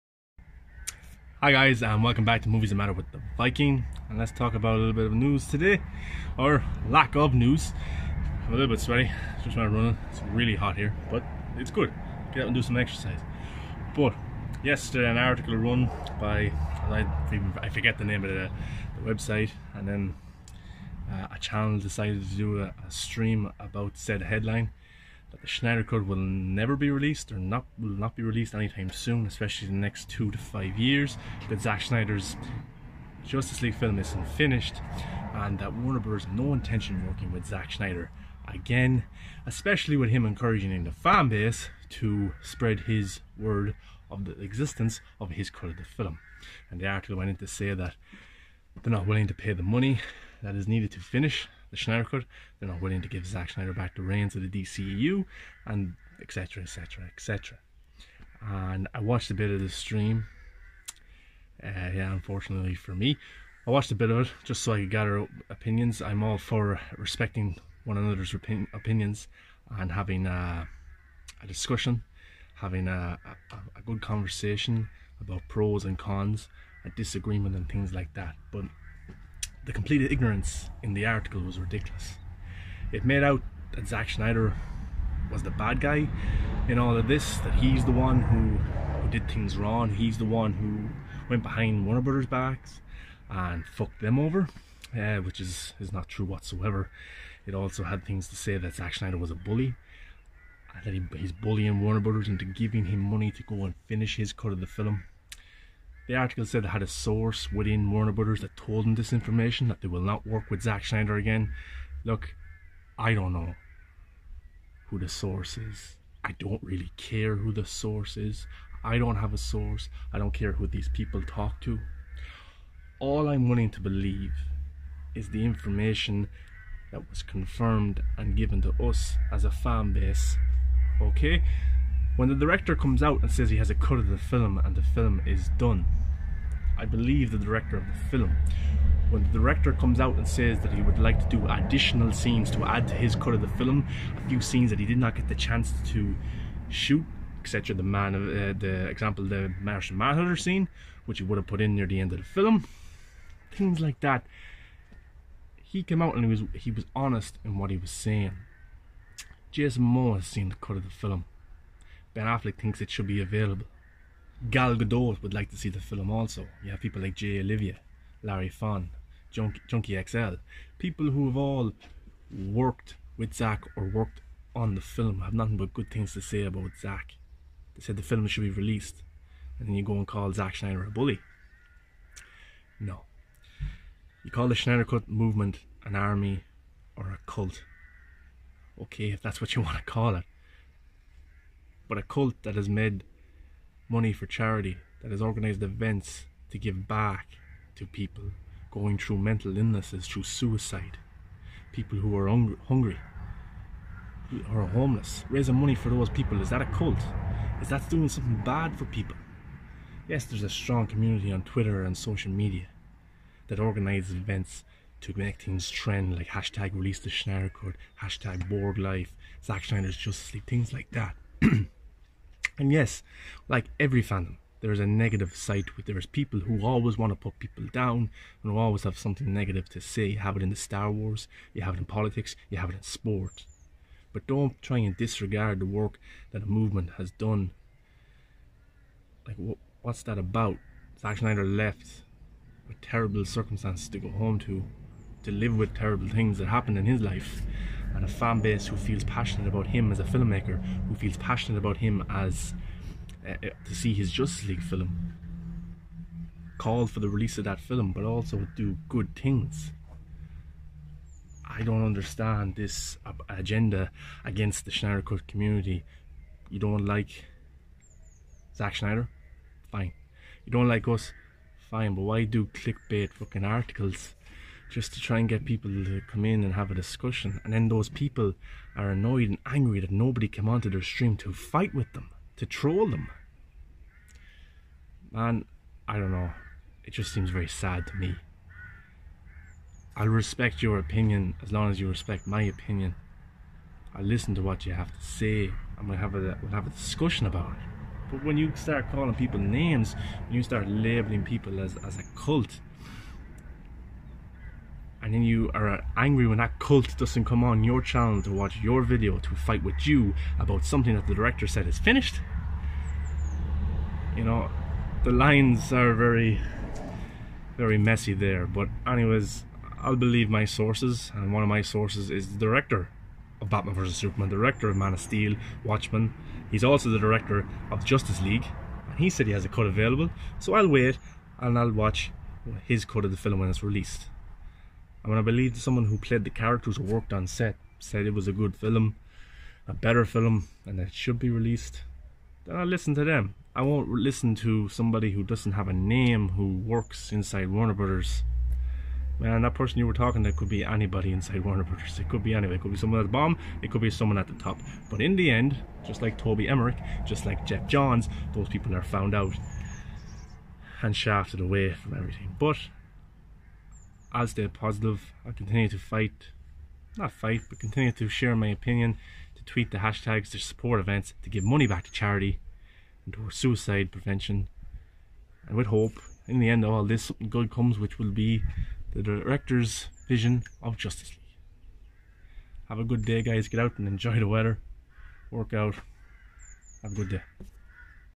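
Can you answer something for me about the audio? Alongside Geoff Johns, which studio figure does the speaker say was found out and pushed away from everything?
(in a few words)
Toby Emmerich.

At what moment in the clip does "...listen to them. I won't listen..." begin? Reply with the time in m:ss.
5:42.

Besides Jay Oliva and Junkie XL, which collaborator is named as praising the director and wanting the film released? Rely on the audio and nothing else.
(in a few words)
Larry Fong.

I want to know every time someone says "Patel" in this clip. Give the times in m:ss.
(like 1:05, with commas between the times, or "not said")
not said.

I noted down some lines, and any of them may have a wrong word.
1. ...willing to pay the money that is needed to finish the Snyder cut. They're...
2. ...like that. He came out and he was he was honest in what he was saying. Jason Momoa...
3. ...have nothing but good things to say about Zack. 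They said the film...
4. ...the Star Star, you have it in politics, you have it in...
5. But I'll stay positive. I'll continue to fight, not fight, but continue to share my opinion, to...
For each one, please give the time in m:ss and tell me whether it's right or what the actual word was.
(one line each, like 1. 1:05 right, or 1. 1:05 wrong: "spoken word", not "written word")
1. 0:49 right
2. 2:33 right
3. 2:55 right
4. 3:50 wrong: "Wars", not "Star"
5. 6:02 right.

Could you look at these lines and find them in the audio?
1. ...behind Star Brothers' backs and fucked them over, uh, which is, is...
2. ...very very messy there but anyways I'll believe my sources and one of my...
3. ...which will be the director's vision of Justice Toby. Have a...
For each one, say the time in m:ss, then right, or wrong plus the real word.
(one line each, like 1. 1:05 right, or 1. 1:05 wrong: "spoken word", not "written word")
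1. 1:31 wrong: "Warner", not "Star"
2. 5:15 right
3. 6:17 wrong: "League", not "Toby".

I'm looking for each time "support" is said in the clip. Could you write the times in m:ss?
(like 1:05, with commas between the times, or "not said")
6:10.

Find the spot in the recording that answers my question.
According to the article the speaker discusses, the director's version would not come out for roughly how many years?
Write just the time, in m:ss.
0:30.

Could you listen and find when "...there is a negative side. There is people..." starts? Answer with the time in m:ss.
3:44.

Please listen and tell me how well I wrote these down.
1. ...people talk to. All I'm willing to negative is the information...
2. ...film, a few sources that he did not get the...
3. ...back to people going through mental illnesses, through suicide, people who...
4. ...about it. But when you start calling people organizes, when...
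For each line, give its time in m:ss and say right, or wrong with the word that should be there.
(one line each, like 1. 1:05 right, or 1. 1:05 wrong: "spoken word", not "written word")
1. 2:00 wrong: "believe", not "negative"
2. 2:23 wrong: "scenes", not "sources"
3. 3:16 right
4. 4:57 wrong: "names", not "organizes".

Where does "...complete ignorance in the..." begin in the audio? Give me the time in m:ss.
1:19.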